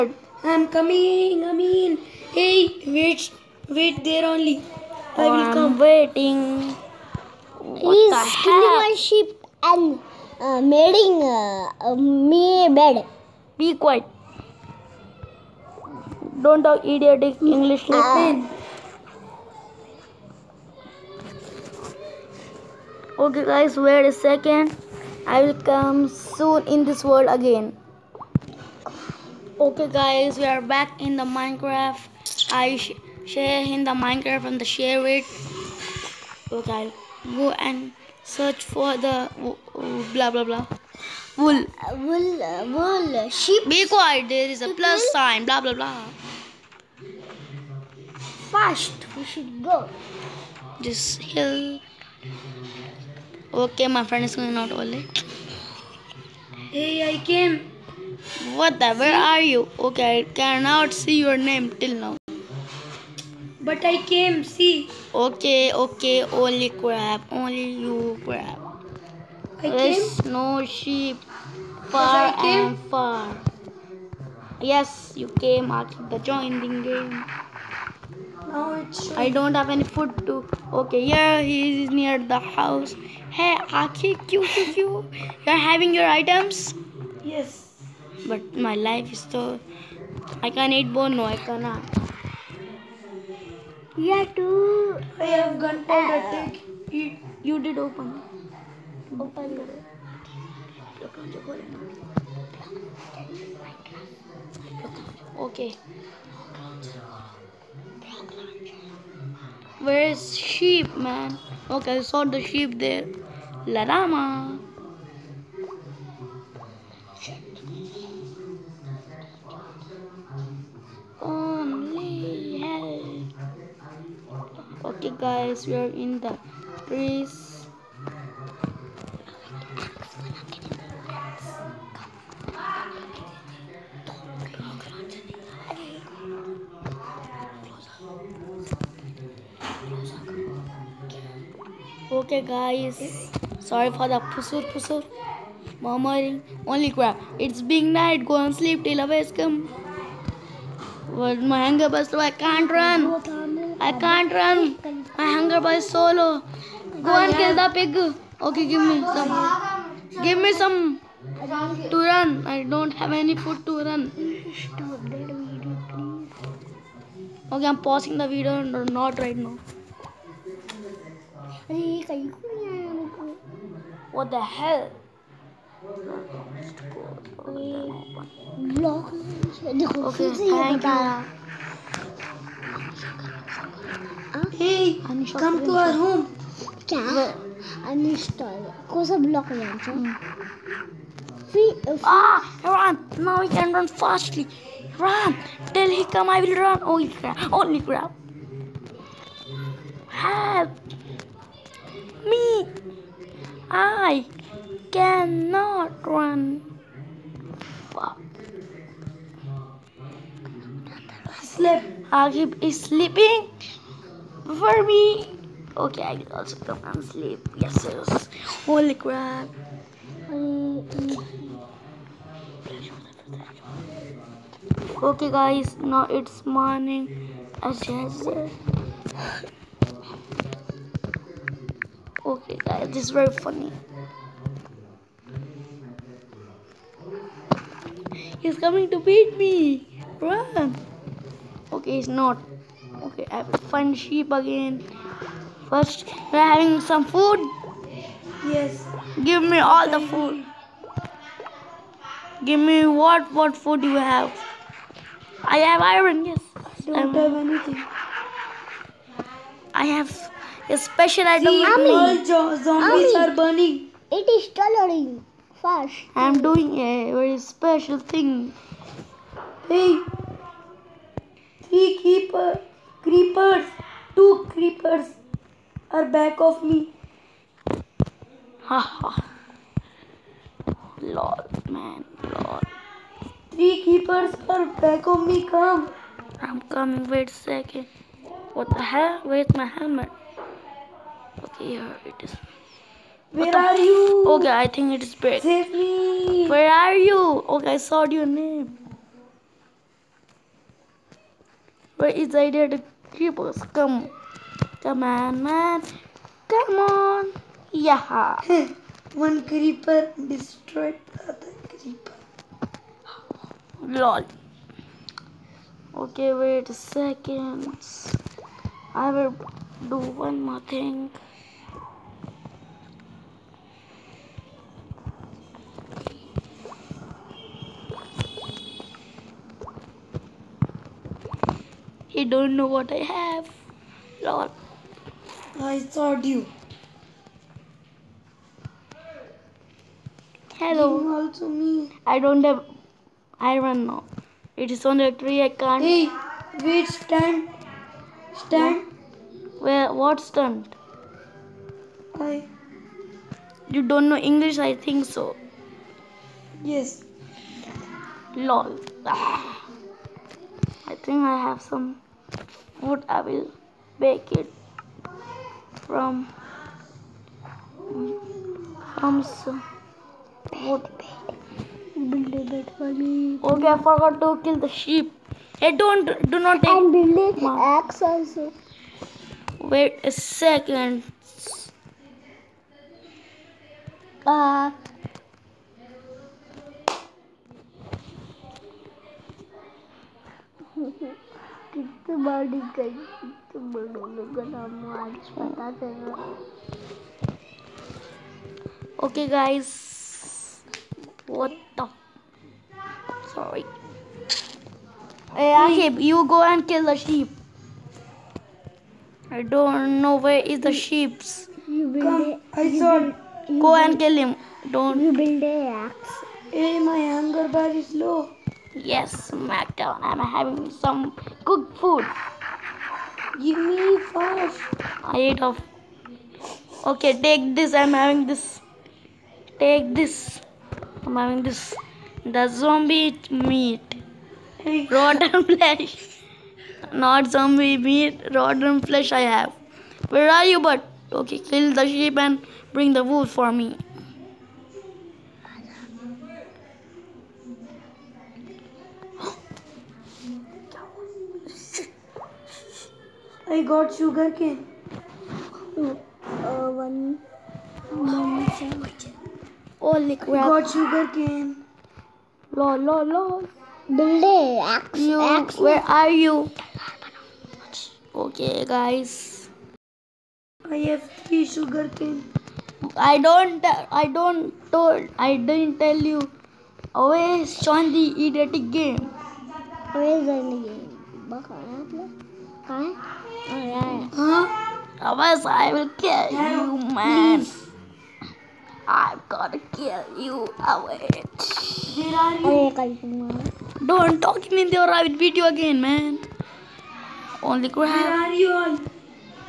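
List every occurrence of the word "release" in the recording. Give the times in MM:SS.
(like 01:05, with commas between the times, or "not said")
not said.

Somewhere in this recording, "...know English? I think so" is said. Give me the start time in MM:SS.
05:54.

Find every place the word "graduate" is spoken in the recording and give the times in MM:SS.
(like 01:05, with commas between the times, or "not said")
not said.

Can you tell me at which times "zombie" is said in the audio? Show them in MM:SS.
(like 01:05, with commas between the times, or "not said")
04:22, 07:12, 07:17.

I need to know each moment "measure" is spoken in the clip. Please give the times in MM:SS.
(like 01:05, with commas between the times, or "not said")
not said.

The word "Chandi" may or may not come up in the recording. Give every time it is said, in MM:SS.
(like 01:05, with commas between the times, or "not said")
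07:57.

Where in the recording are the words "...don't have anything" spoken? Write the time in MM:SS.
04:16.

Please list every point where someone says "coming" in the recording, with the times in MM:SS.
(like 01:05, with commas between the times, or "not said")
00:00, 03:58, 04:46.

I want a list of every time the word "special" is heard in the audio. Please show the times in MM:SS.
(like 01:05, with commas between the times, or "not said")
04:20, 04:27.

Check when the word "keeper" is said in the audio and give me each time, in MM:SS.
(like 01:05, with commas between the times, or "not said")
04:32, 04:43.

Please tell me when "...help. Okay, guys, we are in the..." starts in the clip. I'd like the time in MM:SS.
02:02.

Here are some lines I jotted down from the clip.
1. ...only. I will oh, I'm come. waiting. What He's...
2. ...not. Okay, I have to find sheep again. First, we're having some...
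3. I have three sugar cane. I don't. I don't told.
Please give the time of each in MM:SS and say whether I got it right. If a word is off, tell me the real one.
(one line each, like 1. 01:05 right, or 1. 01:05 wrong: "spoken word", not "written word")
1. 00:04 right
2. 04:02 right
3. 07:50 right.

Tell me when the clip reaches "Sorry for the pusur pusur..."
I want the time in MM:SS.
02:23.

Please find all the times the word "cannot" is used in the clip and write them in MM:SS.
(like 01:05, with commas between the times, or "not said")
01:00, 01:31, 03:24.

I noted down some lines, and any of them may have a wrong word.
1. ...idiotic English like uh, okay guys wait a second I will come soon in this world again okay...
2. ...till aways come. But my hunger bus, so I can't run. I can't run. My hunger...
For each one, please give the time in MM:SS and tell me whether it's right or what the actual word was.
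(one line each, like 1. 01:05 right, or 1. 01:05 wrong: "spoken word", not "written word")
1. 00:16 right
2. 02:28 right.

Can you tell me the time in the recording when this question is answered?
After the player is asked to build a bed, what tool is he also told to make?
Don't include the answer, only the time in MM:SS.
06:17.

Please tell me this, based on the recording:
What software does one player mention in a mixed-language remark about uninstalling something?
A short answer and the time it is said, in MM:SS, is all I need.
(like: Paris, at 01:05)
Block launcher, at 03:09.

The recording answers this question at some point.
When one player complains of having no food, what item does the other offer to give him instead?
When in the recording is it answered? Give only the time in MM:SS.
01:35.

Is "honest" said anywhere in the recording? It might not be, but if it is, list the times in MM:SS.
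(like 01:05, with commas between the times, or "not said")
not said.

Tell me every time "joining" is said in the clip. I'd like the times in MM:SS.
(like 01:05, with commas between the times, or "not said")
01:16.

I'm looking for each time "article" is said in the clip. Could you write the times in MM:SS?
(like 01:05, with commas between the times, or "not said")
not said.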